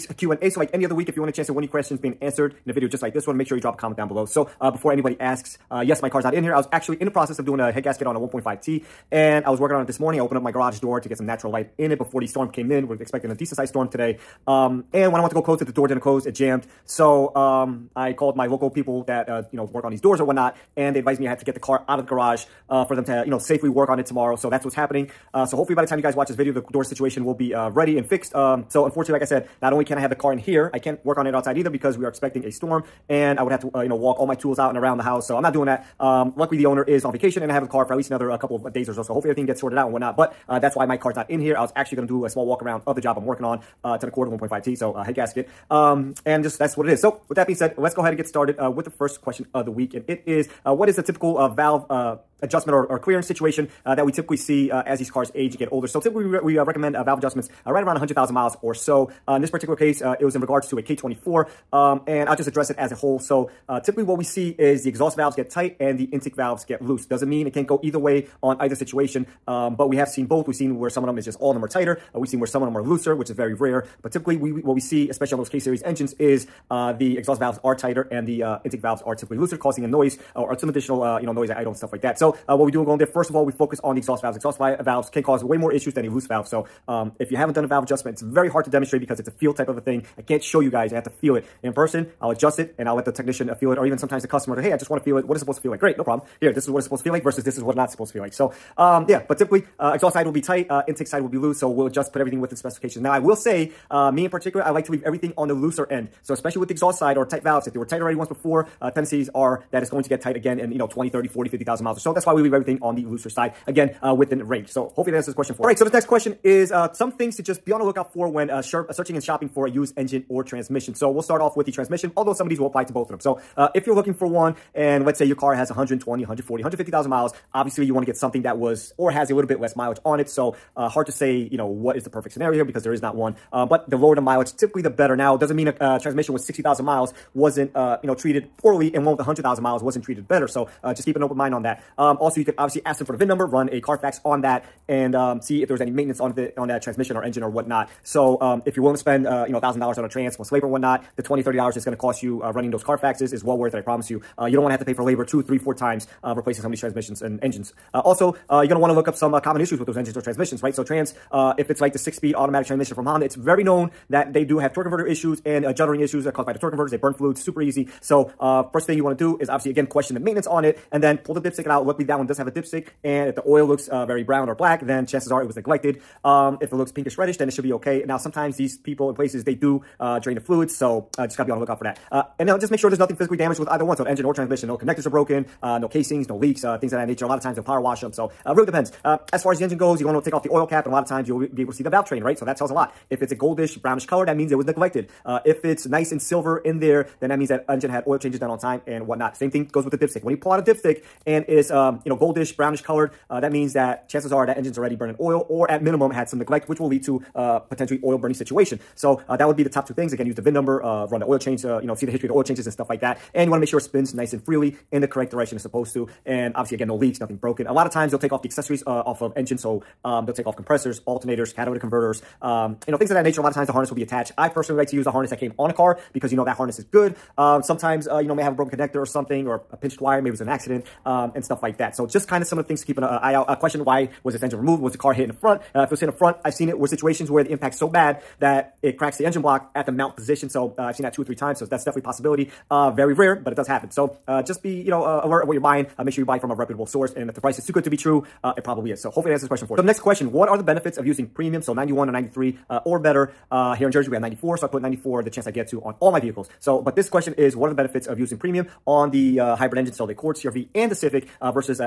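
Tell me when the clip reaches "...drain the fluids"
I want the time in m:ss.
3:00.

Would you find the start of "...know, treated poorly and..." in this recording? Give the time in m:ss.
2:18.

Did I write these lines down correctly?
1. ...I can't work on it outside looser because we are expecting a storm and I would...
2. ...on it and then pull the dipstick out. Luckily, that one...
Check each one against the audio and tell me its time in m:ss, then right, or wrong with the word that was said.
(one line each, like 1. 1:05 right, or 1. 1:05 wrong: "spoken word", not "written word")
1. 0:30 wrong: "either", not "looser"
2. 2:50 right.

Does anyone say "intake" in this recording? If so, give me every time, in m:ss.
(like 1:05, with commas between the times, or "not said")
1:06, 1:18, 1:40.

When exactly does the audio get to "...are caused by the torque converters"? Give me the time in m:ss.
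2:46.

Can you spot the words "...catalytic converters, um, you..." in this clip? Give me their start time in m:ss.
3:41.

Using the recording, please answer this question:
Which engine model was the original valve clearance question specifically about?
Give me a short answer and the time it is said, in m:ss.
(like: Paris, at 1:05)
K24, at 1:00.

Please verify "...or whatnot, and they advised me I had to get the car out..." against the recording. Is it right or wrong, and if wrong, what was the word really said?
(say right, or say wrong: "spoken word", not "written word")
right.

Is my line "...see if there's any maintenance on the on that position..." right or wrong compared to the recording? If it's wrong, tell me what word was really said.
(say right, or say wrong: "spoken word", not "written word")
wrong: "transmission", not "position".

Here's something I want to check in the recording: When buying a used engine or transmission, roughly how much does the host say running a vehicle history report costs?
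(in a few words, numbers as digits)
$20 to $30.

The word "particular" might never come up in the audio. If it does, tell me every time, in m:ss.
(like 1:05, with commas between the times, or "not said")
0:59, 1:44.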